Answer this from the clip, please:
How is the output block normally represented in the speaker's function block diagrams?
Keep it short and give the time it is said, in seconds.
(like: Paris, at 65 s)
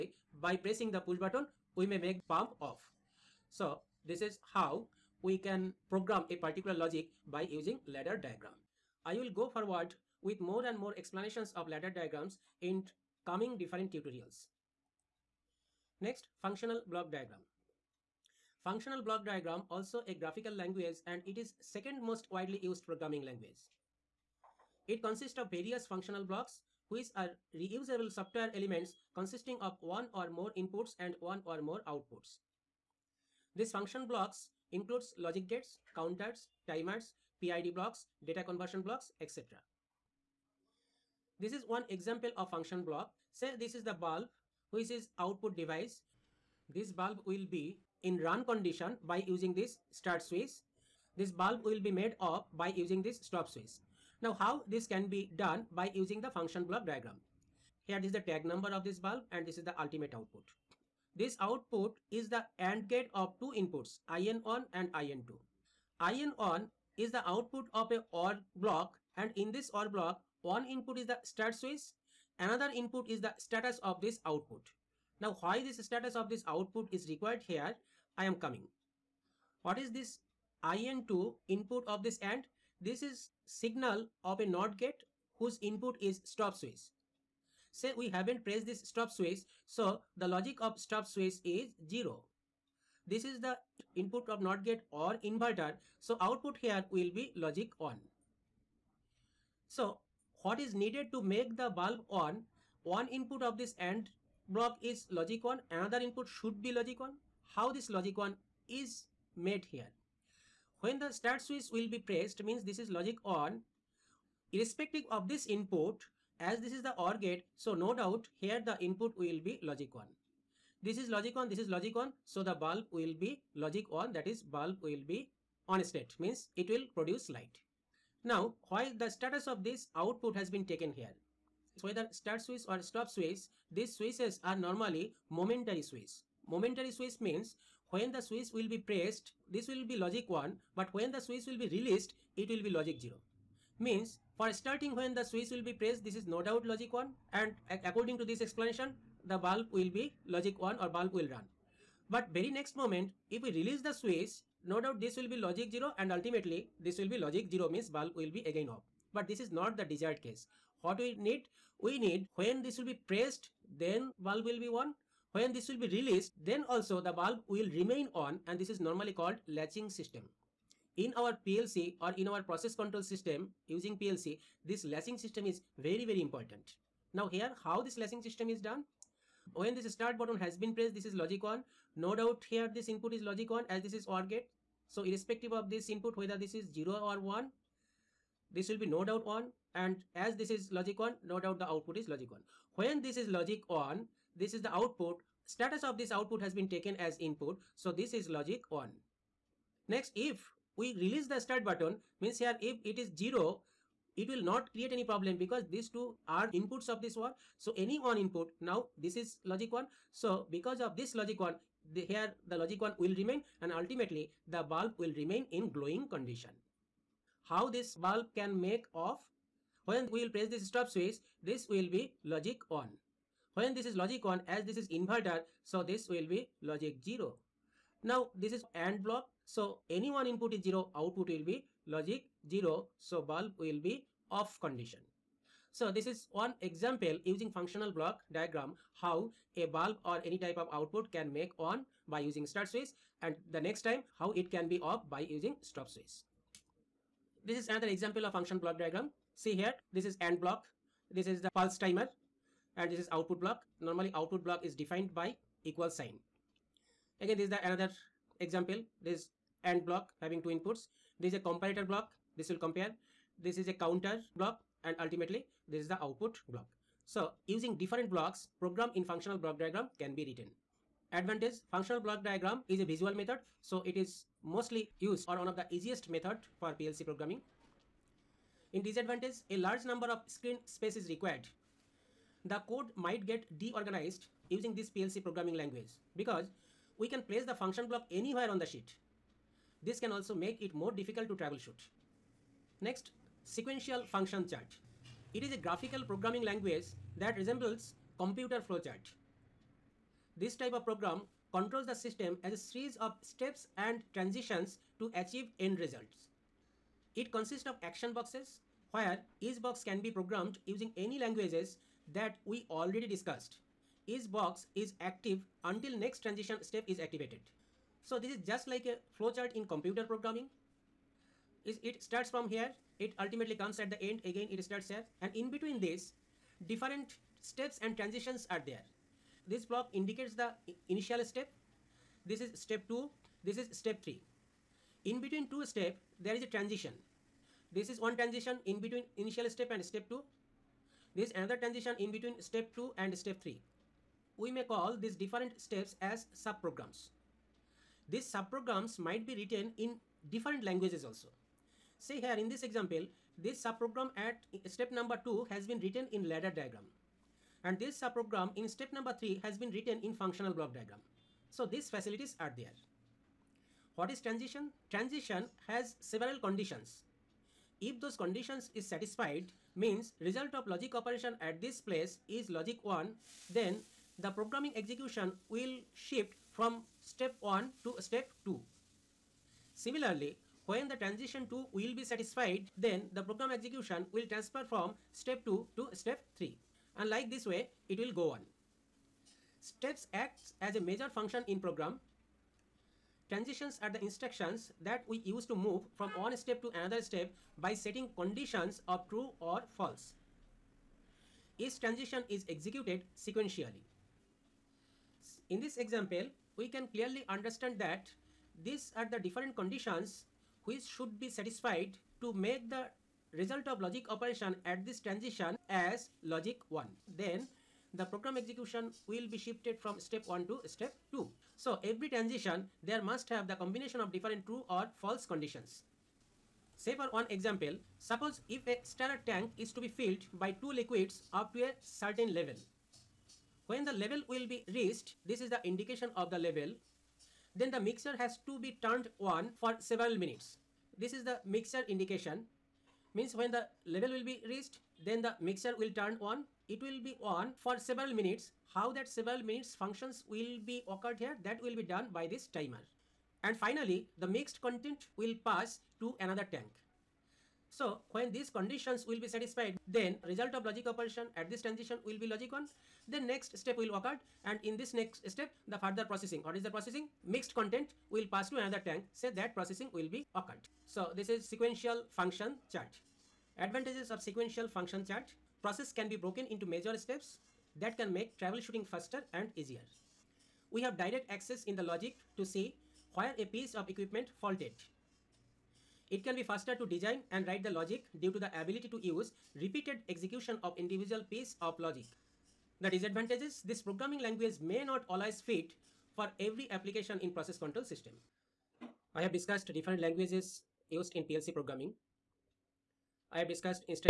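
Equal sign, at 255 s.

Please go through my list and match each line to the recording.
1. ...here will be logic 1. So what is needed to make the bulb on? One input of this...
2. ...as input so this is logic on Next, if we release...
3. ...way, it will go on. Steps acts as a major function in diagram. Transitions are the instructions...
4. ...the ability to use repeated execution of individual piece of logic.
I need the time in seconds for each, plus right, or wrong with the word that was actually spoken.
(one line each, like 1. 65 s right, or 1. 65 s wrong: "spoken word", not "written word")
1. 96 s right
2. 196 s right
3. 387 s wrong: "program", not "diagram"
4. 488 s right.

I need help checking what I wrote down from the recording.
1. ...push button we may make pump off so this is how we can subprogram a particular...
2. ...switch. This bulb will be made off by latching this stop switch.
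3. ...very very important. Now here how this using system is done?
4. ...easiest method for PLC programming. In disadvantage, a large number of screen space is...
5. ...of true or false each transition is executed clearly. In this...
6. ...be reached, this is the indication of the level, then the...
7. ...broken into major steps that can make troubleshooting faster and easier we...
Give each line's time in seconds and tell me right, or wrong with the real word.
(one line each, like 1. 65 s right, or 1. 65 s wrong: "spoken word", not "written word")
1. 0 s wrong: "program", not "subprogram"
2. 50 s wrong: "using", not "latching"
3. 175 s wrong: "latching", not "using"
4. 275 s right
5. 398 s wrong: "sequentially", not "clearly"
6. 434 s right
7. 476 s right.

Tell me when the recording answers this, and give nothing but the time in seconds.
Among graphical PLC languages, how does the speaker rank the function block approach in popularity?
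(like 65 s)
21 s.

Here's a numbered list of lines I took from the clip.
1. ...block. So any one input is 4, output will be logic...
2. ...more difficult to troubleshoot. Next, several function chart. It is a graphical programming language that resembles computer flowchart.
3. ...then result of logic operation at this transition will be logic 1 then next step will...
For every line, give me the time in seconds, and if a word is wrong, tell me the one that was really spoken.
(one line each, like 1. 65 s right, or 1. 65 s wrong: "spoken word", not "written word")
1. 229 s wrong: "0", not "4"
2. 290 s wrong: "sequential", not "several"
3. 459 s right.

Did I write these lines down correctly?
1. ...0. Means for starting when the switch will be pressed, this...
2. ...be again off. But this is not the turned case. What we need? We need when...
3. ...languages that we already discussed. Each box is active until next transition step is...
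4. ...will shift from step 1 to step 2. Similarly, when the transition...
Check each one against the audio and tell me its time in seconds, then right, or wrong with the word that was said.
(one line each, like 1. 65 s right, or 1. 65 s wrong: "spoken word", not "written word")
1. 142 s right
2. 158 s wrong: "desired", not "turned"
3. 311 s right
4. 375 s right.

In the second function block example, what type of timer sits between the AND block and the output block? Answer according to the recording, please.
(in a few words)
Pulse timer.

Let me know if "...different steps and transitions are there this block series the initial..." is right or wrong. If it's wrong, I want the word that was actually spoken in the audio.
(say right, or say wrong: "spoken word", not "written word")
wrong: "indicates", not "series".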